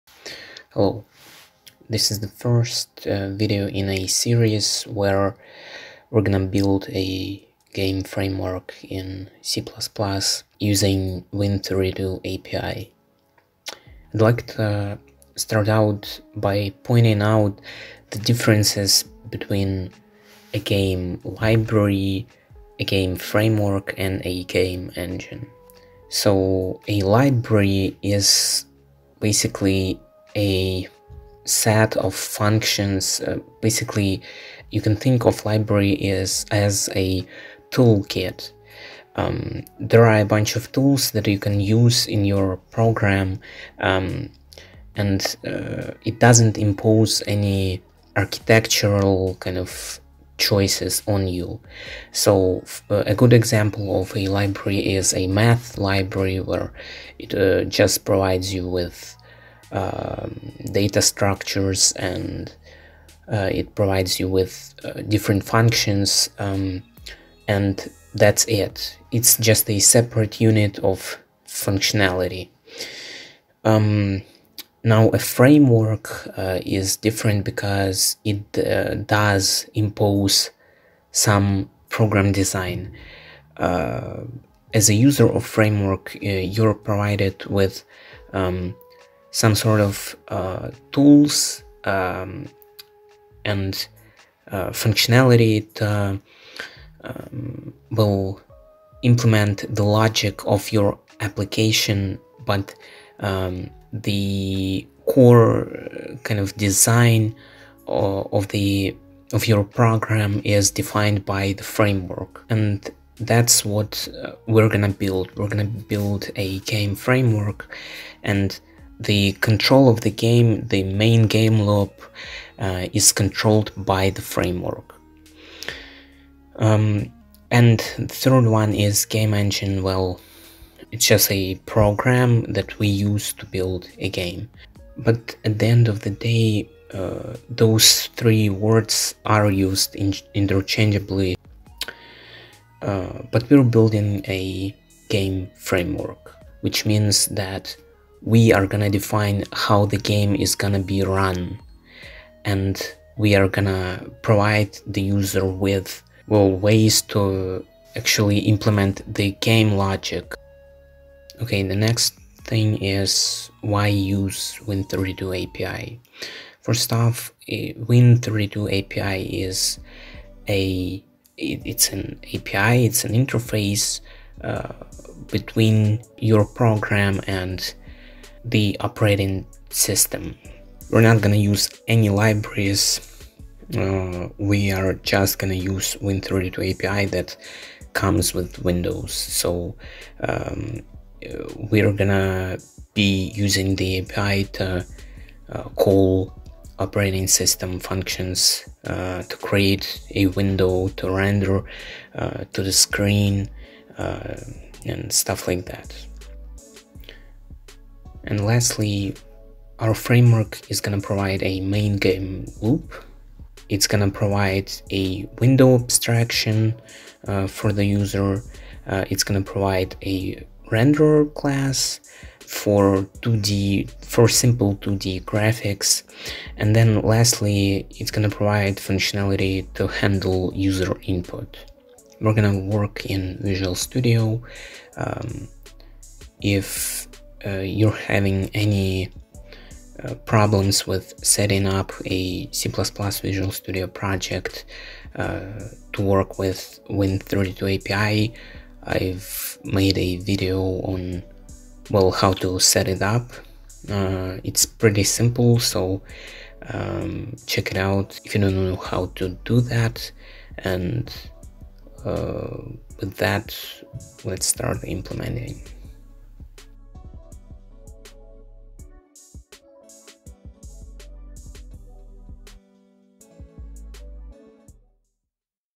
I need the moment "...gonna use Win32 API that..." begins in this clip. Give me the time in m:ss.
3:05.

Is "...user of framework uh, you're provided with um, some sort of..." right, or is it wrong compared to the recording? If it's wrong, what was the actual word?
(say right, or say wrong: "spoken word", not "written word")
right.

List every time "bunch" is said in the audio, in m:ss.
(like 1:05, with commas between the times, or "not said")
0:40.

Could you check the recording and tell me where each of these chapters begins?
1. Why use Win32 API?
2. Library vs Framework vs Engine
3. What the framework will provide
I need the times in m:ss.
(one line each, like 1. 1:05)
1. 2:40
2. 0:14
3. 3:28.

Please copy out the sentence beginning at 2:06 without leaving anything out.
Um, and the third one is game engine.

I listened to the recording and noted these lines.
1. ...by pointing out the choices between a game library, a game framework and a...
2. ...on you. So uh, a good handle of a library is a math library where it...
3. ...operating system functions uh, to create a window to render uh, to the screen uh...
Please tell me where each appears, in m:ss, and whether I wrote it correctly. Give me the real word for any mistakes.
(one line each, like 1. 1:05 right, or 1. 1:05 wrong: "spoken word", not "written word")
1. 0:16 wrong: "differences", not "choices"
2. 0:51 wrong: "example", not "handle"
3. 3:16 right.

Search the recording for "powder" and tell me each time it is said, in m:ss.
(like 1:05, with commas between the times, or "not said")
not said.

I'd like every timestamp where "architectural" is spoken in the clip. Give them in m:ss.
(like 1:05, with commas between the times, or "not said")
0:48.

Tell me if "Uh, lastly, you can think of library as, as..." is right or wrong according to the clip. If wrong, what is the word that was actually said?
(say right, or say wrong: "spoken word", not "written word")
wrong: "basically", not "lastly".